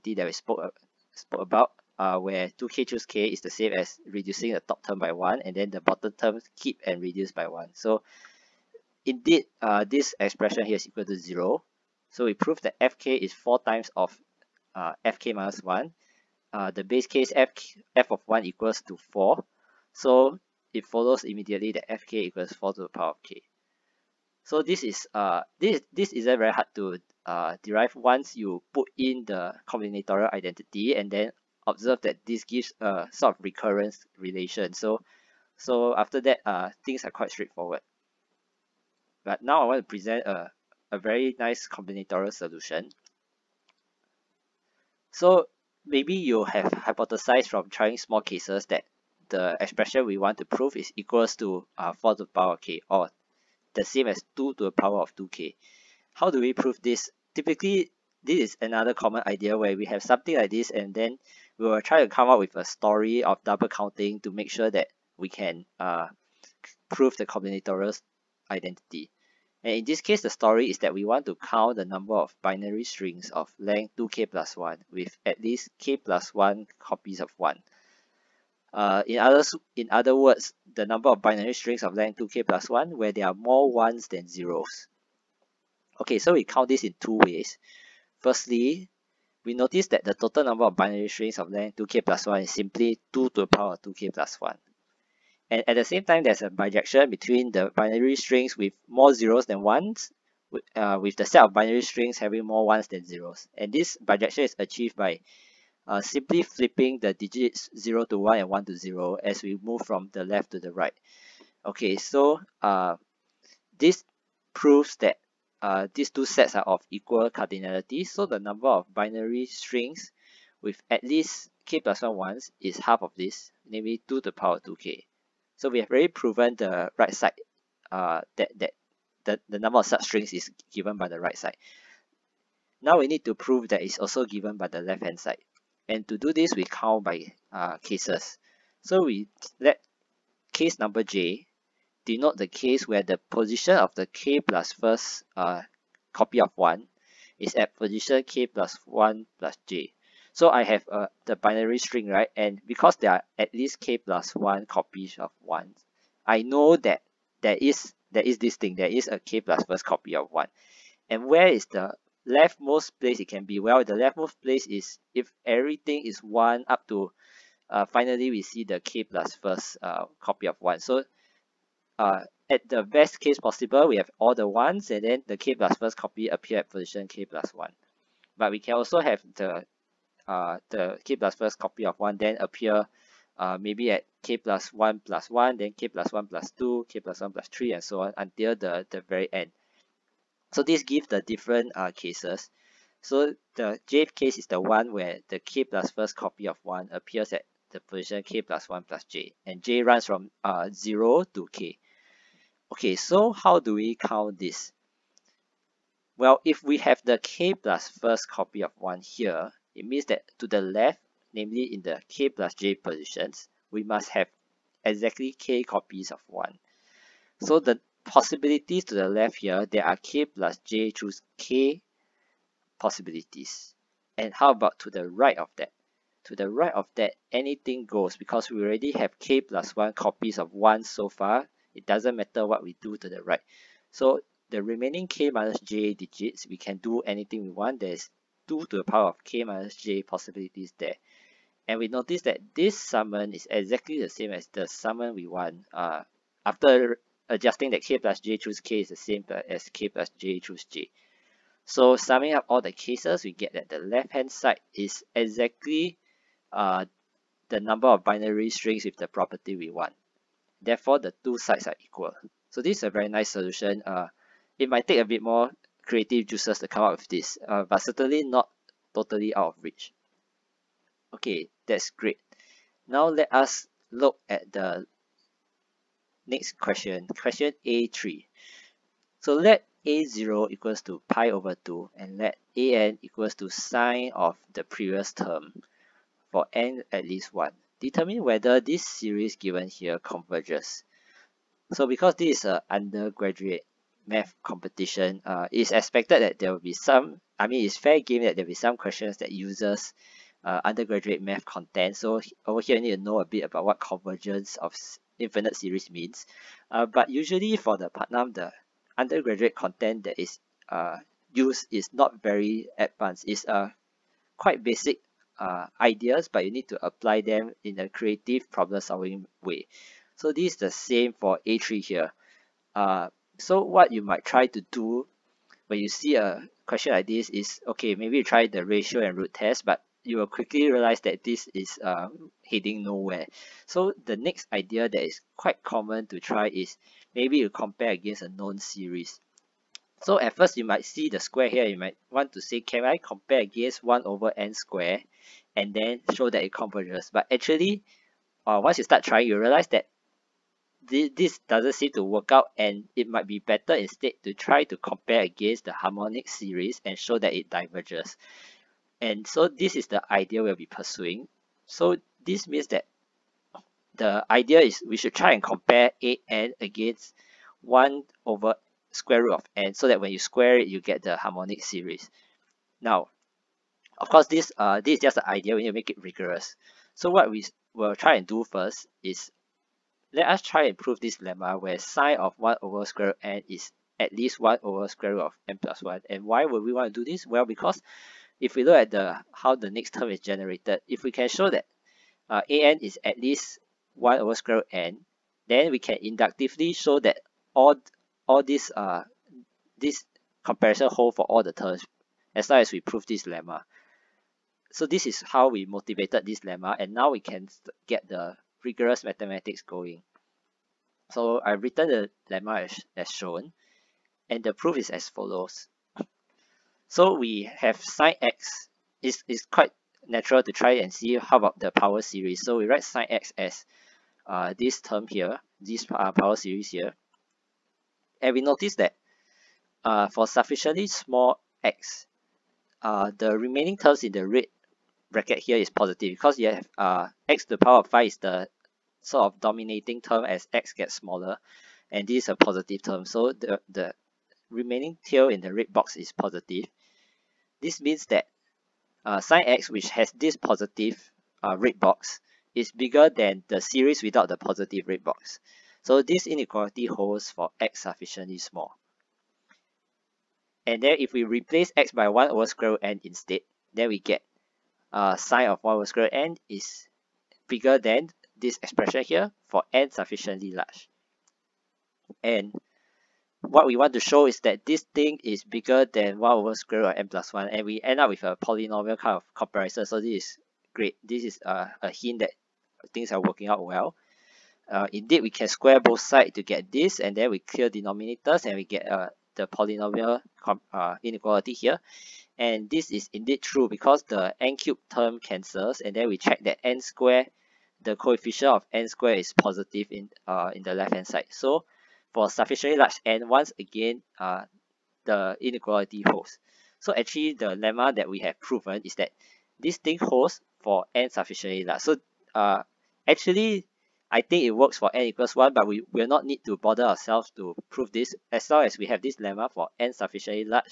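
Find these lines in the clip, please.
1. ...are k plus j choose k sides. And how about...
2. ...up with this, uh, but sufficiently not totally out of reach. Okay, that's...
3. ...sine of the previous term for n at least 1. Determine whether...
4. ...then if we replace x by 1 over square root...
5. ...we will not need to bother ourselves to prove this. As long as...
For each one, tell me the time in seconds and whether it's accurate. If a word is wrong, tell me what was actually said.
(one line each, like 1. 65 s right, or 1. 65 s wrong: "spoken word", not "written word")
1. 219 s wrong: "possibilities", not "sides"
2. 266 s wrong: "certainly", not "sufficiently"
3. 283 s right
4. 460 s right
5. 515 s right.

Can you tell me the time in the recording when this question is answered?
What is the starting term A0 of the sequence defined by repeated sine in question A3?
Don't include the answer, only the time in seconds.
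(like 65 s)
279 s.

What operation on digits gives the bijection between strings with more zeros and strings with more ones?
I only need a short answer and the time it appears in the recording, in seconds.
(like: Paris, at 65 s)
Flipping the digits, at 106 s.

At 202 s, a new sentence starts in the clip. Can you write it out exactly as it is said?
Okay, so how do we count this?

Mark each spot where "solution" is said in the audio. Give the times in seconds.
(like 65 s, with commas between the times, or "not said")
42 s, 263 s.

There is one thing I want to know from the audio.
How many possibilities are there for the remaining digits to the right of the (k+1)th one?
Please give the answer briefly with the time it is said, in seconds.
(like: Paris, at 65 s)
2 to the power k minus j, at 238 s.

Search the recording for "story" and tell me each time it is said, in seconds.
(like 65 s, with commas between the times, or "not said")
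62 s, 70 s.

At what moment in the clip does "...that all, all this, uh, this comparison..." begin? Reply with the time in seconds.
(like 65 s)
396 s.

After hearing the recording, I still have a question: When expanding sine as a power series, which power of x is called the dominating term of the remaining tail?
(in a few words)
x to the power 5.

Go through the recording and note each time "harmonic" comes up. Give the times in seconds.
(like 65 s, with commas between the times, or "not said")
355 s, 371 s.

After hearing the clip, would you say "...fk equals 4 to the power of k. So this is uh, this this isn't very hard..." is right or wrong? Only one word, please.
right.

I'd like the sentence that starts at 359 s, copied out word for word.
And so this is the idea we'll be pursuing.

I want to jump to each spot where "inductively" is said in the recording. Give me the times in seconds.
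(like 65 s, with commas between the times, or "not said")
395 s.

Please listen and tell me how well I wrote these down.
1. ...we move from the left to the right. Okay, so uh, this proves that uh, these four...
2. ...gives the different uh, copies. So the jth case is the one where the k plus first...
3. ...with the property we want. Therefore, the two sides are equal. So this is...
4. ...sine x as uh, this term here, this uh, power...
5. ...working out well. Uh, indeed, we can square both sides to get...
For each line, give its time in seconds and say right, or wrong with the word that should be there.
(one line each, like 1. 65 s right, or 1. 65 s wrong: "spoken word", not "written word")
1. 109 s wrong: "two", not "four"
2. 190 s wrong: "cases", not "copies"
3. 258 s right
4. 422 s right
5. 483 s right.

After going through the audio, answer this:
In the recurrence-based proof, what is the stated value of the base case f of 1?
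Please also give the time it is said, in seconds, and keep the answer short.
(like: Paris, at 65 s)
4, at 17 s.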